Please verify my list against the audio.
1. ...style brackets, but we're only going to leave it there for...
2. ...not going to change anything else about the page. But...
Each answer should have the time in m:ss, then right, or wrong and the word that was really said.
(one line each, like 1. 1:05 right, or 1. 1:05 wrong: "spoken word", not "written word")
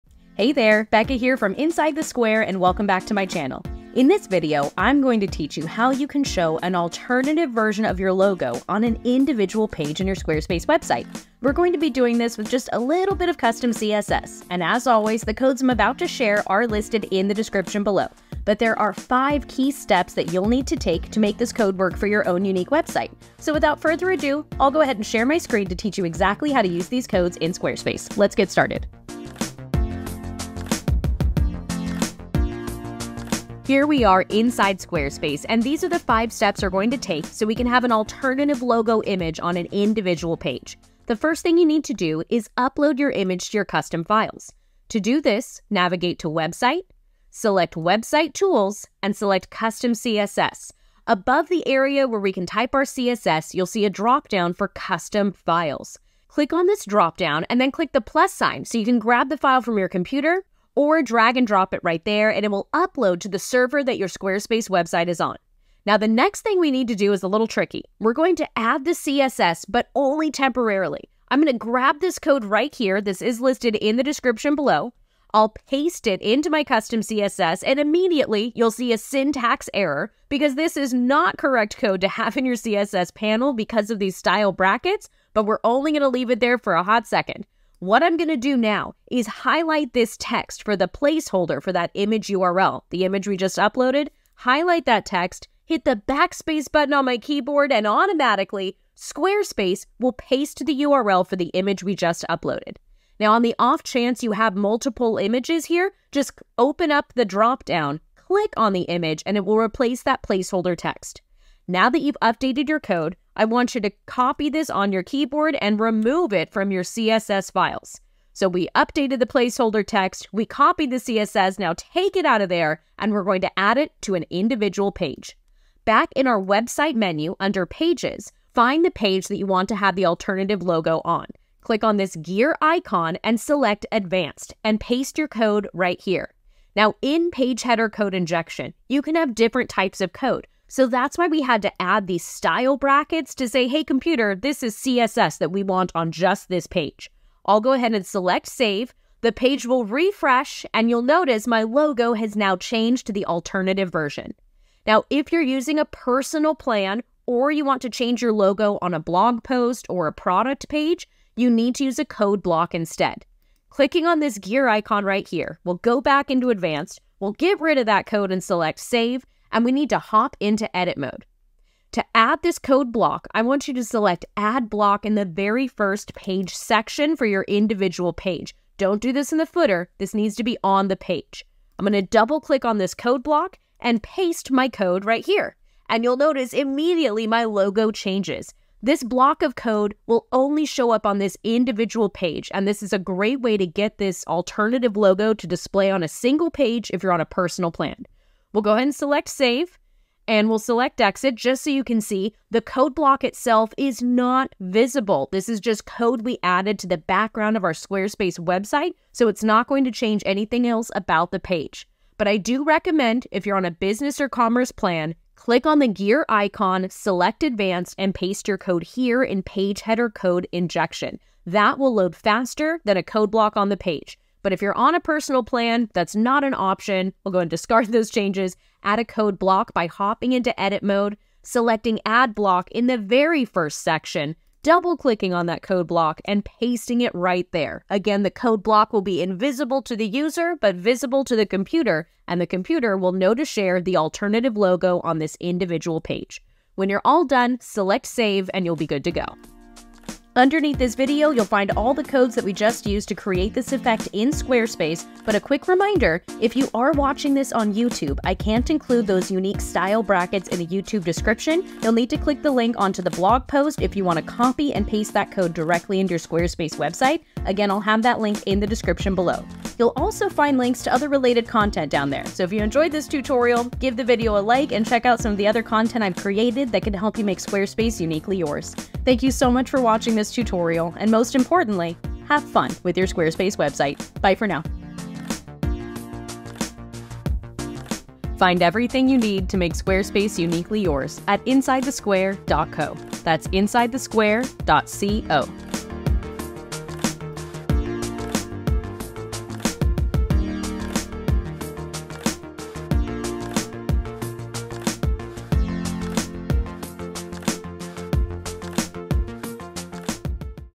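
1. 1:24 right
2. 3:29 right.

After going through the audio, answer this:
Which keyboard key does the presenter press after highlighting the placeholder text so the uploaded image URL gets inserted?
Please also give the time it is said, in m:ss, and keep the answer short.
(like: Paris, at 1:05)
backspace, at 1:35.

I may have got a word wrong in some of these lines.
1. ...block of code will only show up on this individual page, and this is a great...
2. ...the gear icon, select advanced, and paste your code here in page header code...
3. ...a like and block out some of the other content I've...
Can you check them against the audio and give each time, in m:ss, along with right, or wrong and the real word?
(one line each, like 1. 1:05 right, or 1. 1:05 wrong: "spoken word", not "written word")
1. 3:09 right
2. 3:35 right
3. 4:34 wrong: "check", not "block".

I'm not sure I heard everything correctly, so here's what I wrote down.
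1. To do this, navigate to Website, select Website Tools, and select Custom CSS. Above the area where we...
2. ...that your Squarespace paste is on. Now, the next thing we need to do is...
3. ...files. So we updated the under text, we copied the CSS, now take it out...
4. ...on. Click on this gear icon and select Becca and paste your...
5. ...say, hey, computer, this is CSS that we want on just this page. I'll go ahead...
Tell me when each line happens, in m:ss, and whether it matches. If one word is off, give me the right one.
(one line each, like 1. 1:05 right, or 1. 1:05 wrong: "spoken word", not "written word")
1. 0:44 right
2. 1:03 wrong: "website", not "paste"
3. 1:57 wrong: "placeholder", not "under"
4. 2:11 wrong: "Advanced", not "Becca"
5. 2:23 right.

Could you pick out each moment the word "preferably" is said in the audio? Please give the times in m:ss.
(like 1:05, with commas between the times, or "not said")
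not said.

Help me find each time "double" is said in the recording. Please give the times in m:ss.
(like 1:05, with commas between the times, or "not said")
3:02, 3:54.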